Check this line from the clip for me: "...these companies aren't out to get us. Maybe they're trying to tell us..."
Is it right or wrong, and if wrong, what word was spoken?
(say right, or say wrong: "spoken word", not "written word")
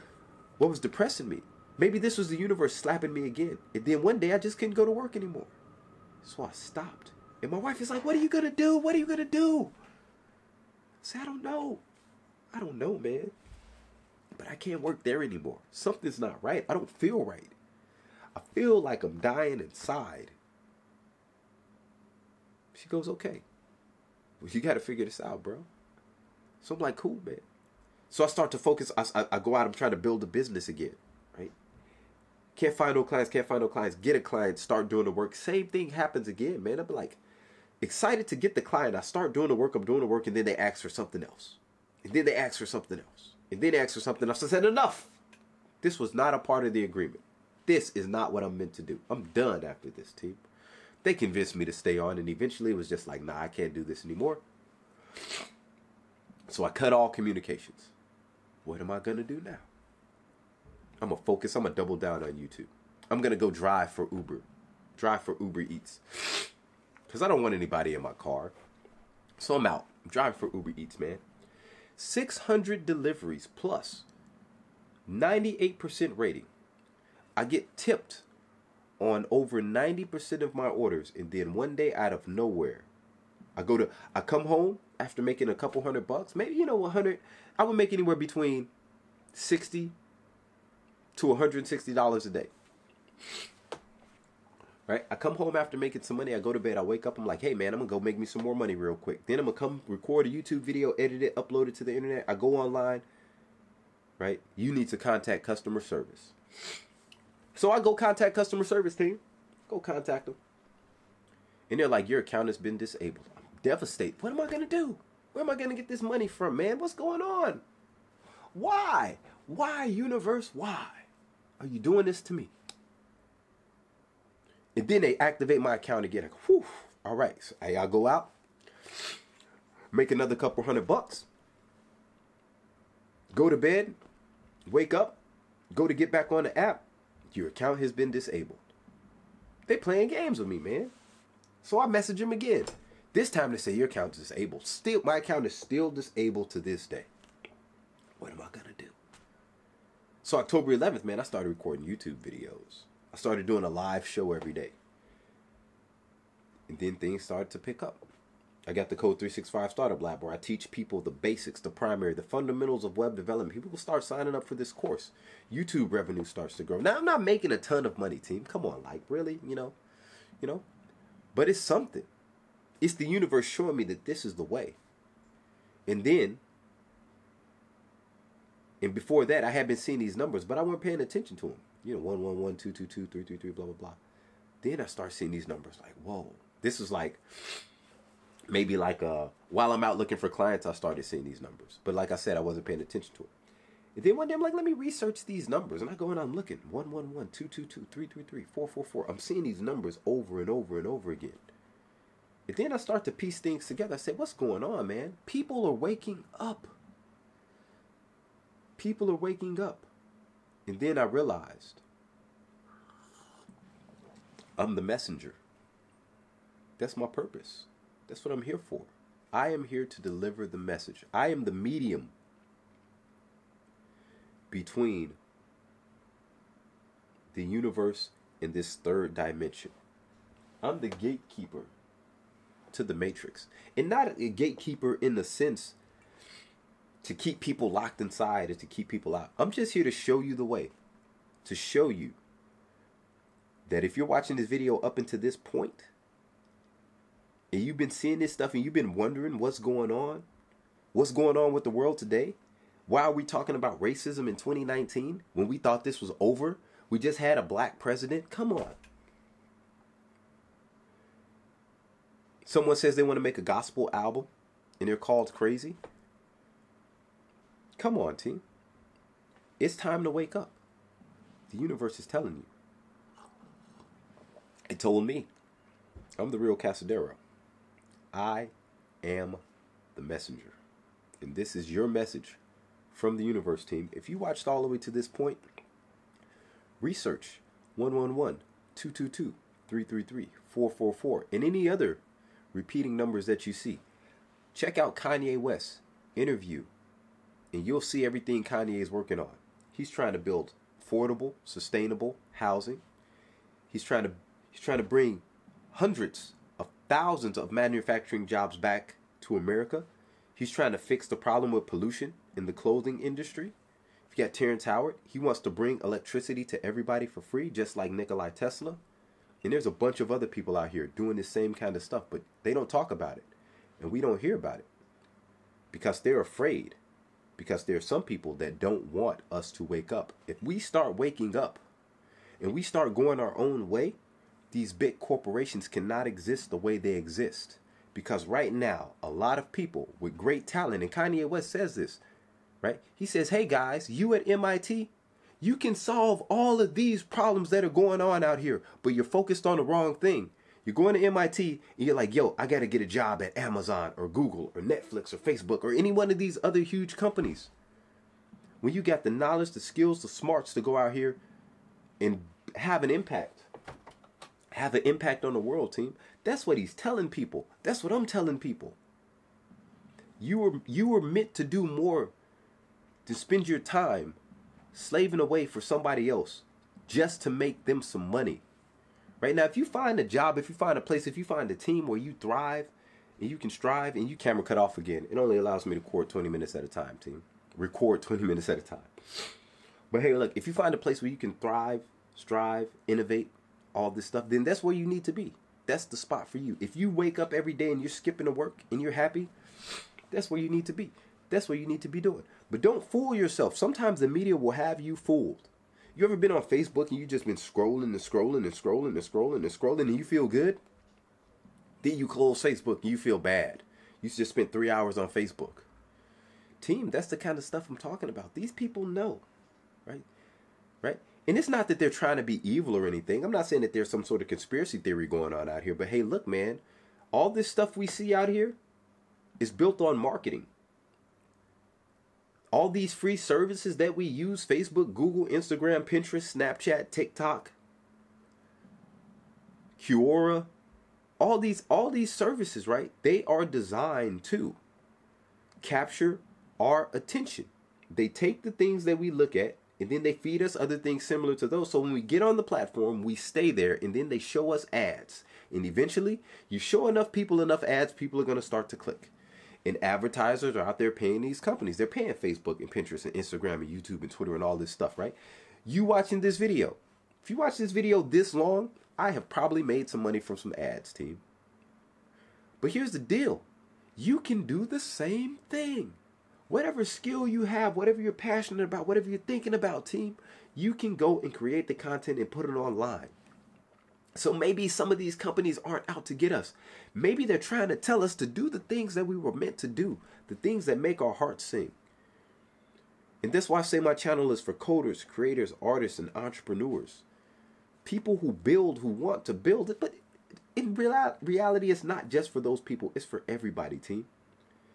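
right.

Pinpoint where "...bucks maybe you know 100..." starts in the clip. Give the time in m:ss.
1:26.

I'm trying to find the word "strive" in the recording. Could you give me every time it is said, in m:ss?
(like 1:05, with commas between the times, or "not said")
6:23, 6:32.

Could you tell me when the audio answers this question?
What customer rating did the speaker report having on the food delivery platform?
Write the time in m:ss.
1:15.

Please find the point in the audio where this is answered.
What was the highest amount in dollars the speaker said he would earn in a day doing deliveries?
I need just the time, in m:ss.
1:31.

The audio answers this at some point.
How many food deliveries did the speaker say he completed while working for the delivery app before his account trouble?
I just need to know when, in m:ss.
1:11.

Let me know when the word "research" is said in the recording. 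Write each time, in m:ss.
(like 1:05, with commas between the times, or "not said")
3:14, 4:46.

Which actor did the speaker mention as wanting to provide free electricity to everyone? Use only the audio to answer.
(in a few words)
Terrence Howard.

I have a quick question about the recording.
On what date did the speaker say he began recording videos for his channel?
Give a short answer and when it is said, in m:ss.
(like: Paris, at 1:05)
October 11th, at 2:30.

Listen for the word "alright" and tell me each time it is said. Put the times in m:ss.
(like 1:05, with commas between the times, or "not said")
not said.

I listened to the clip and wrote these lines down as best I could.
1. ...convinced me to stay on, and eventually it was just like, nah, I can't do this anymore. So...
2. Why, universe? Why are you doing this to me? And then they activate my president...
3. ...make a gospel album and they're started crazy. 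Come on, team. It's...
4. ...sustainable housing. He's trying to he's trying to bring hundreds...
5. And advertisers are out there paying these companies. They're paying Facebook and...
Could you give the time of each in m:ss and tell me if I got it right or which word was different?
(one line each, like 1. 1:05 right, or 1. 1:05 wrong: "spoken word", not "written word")
1. 0:51 right
2. 1:59 wrong: "account", not "president"
3. 4:23 wrong: "called", not "started"
4. 5:01 right
5. 7:39 right.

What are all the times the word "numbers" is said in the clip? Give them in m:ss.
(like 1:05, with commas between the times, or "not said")
3:00, 3:05, 3:11, 3:15, 3:19, 4:52.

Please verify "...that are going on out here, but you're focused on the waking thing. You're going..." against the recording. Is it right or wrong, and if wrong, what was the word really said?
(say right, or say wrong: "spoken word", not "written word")
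wrong: "wrong", not "waking".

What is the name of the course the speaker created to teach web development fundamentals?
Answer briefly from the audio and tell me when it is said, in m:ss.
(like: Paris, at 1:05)
Code 365 Startup Lab, at 2:38.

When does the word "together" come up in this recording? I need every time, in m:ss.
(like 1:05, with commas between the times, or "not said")
3:23.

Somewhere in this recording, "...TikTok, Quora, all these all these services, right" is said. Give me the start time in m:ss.
7:16.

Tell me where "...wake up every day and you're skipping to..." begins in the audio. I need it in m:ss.
6:36.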